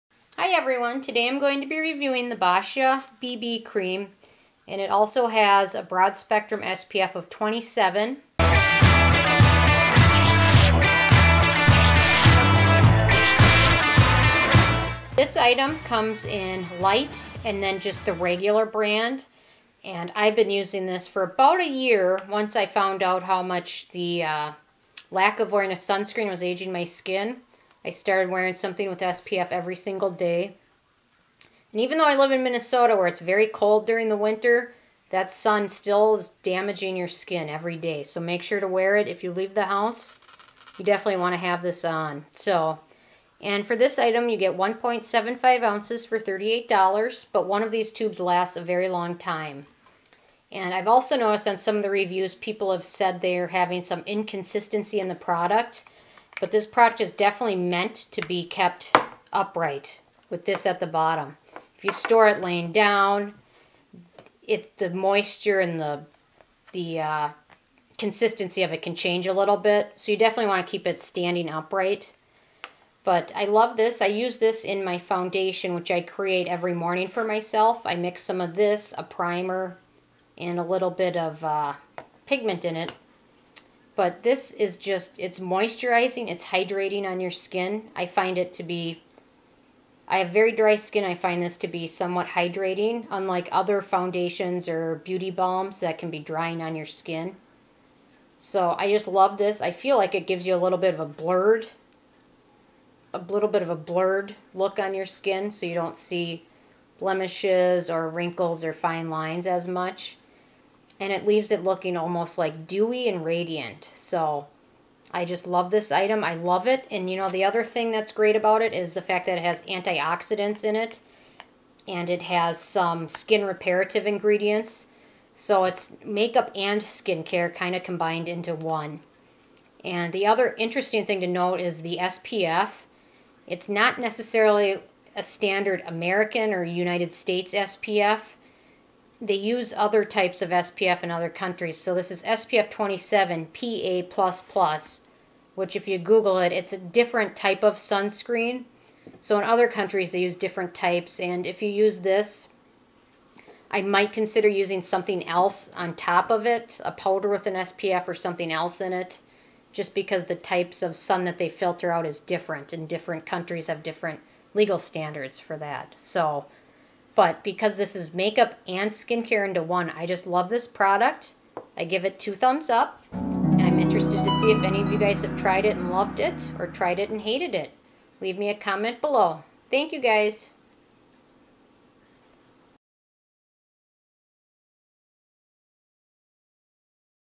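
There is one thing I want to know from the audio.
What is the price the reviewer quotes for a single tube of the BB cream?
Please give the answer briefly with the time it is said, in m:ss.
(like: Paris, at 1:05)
$38, at 0:46.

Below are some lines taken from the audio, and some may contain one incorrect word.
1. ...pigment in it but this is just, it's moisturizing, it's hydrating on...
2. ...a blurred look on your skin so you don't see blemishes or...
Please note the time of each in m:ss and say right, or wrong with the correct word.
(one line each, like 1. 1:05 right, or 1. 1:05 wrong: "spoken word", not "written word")
1. 1:22 right
2. 1:43 right.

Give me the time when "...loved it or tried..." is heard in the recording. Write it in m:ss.
2:55.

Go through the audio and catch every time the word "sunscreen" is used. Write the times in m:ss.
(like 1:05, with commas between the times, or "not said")
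0:25, 2:27.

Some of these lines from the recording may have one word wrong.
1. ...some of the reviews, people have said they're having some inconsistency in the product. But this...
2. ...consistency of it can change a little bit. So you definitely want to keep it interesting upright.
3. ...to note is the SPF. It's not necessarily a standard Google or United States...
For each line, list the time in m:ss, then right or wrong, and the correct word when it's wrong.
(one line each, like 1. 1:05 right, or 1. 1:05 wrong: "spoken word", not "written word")
1. 0:51 right
2. 1:07 wrong: "standing", not "interesting"
3. 2:11 wrong: "American", not "Google".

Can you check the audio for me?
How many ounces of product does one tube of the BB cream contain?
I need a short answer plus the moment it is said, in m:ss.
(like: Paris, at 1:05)
1.75 ounces, at 0:44.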